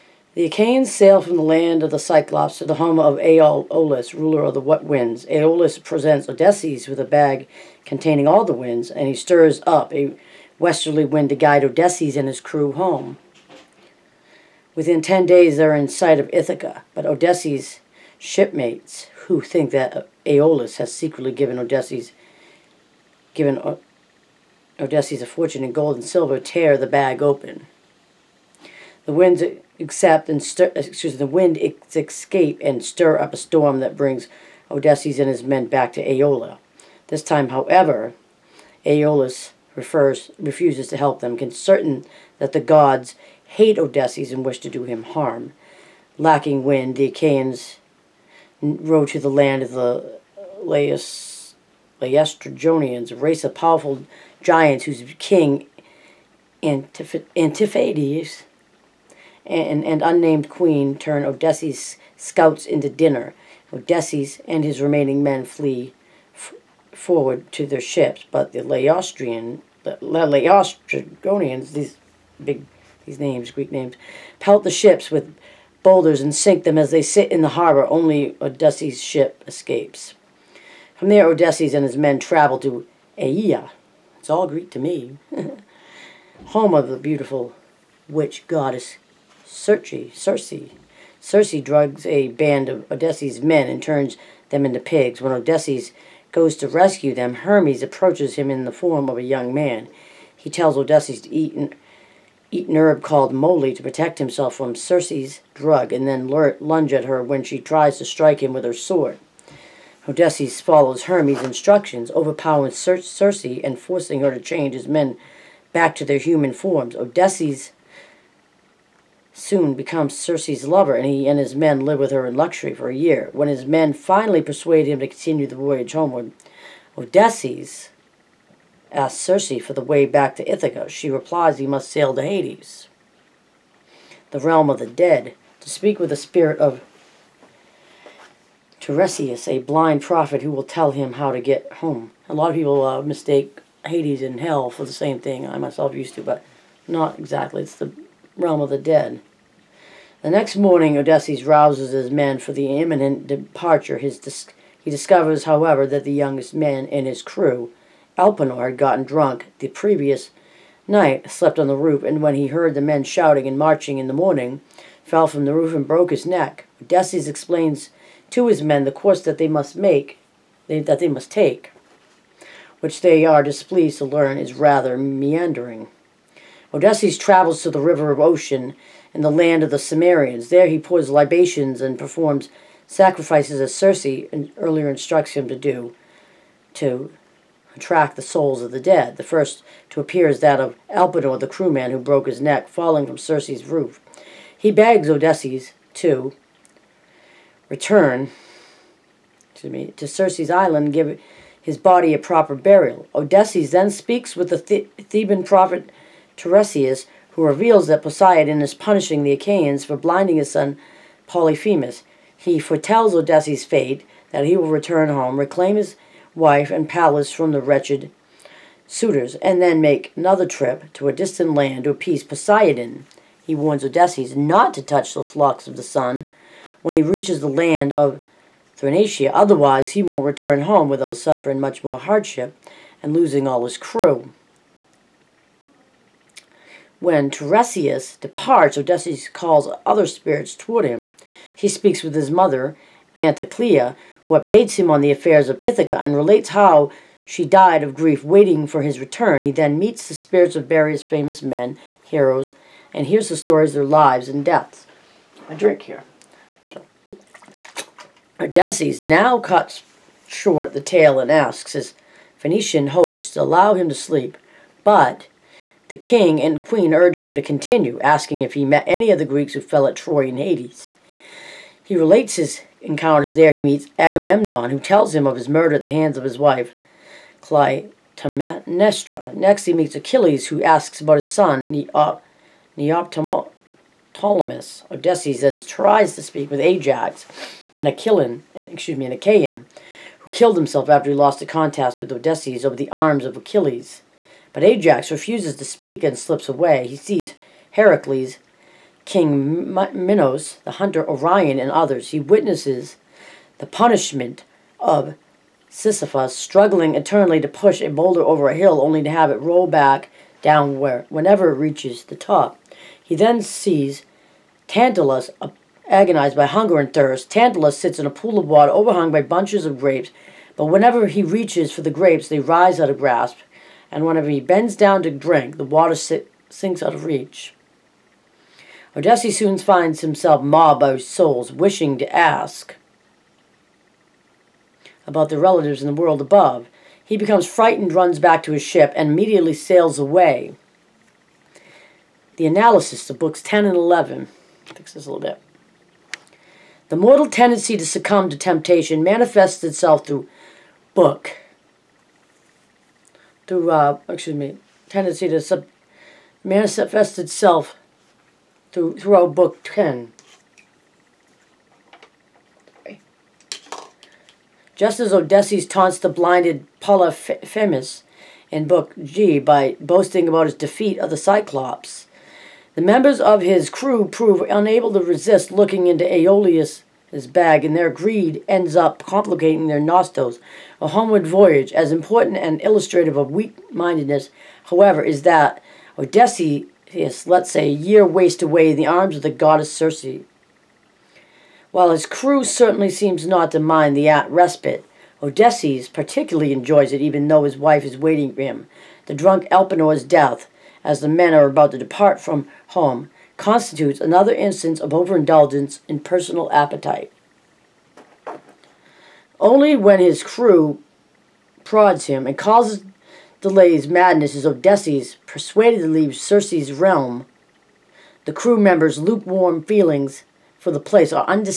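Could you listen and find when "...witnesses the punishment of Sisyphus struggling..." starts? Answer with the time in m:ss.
5:02.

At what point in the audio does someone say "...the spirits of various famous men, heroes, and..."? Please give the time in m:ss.
4:10.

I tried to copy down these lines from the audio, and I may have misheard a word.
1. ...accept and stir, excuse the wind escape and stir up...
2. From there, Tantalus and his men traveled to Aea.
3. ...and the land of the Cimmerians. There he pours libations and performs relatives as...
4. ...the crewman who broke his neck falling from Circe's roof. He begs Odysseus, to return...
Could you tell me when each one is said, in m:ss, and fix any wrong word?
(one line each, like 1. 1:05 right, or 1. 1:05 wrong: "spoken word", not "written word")
1. 0:29 right
2. 1:20 wrong: "Odysseus", not "Tantalus"
3. 2:59 wrong: "sacrifices", not "relatives"
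4. 3:11 right.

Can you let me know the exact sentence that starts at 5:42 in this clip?
The analysis of books 10 and 11.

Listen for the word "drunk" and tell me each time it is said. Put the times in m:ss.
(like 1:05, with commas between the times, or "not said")
2:39, 6:39.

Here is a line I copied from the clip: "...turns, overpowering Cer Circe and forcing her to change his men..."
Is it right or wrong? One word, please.
wrong.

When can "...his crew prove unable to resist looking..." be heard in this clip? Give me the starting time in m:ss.
6:13.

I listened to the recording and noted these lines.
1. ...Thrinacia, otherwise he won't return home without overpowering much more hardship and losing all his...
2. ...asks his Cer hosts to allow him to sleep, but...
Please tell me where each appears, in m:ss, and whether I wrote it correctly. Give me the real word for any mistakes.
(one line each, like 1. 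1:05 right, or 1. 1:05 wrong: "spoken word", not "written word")
1. 3:48 wrong: "suffering", not "overpowering"
2. 4:21 wrong: "Phoenician", not "Cer".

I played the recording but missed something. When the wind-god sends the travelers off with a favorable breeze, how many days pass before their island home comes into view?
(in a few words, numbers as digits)
10.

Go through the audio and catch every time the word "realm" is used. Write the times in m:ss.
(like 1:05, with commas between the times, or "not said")
2:14, 2:28, 6:56.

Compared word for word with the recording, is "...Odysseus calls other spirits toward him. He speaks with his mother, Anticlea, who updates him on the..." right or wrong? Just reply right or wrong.
right.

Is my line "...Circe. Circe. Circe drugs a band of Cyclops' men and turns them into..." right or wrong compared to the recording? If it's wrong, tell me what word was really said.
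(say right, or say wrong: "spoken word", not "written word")
wrong: "Odysseus", not "Cyclops".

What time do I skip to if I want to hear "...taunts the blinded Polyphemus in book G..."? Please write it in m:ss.
6:05.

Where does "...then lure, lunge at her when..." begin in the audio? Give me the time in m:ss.
1:46.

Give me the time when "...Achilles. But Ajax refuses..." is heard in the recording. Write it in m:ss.
4:53.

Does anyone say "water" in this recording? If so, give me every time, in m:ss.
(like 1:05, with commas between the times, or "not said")
5:18, 5:25.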